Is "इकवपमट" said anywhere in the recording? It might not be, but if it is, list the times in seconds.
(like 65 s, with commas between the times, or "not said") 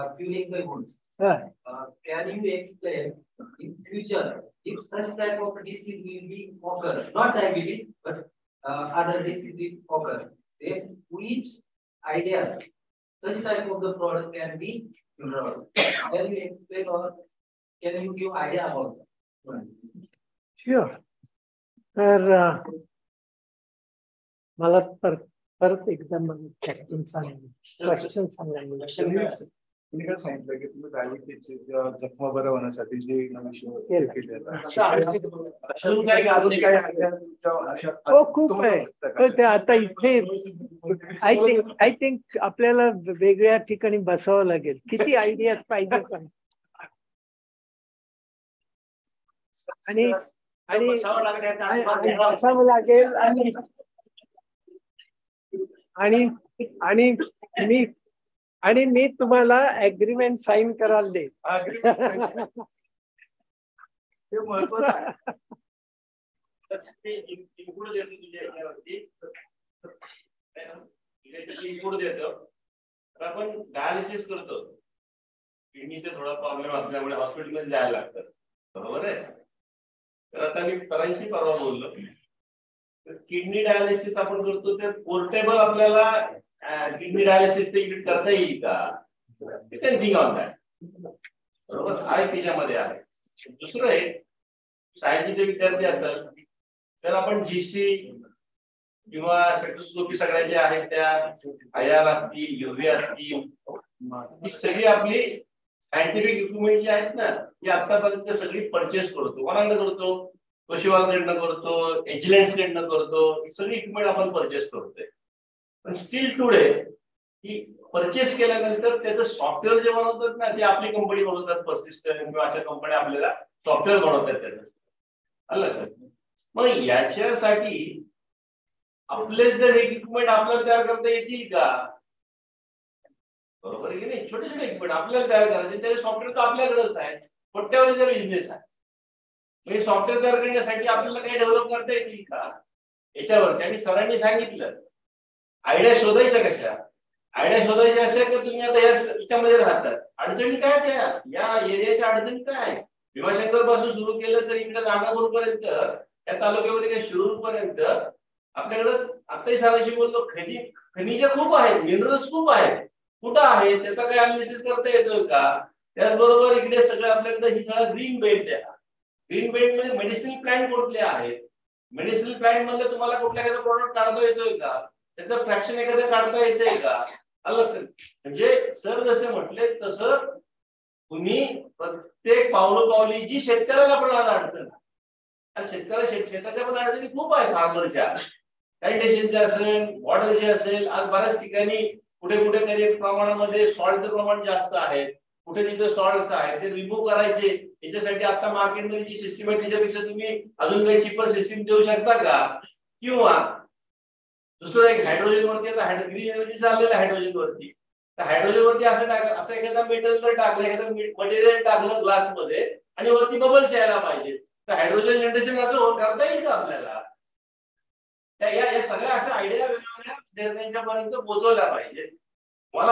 106 s, 113 s, 129 s, 134 s.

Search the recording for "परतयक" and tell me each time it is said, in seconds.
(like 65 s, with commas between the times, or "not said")
181 s.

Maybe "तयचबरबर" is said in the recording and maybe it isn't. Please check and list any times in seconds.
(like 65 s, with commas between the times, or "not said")
165 s.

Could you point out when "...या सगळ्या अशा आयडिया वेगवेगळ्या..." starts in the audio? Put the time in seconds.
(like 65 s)
218 s.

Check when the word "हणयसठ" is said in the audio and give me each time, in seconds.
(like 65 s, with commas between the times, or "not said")
32 s.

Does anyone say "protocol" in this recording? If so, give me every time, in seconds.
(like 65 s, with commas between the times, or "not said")
not said.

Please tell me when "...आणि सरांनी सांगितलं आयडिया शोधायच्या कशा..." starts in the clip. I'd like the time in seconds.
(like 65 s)
143 s.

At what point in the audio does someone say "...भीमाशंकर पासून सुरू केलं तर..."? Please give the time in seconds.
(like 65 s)
153 s.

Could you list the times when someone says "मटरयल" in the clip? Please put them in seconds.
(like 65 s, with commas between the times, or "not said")
211 s.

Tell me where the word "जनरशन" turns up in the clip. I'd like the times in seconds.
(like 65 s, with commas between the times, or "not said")
215 s.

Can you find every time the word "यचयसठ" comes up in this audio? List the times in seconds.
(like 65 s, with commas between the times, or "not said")
126 s, 197 s.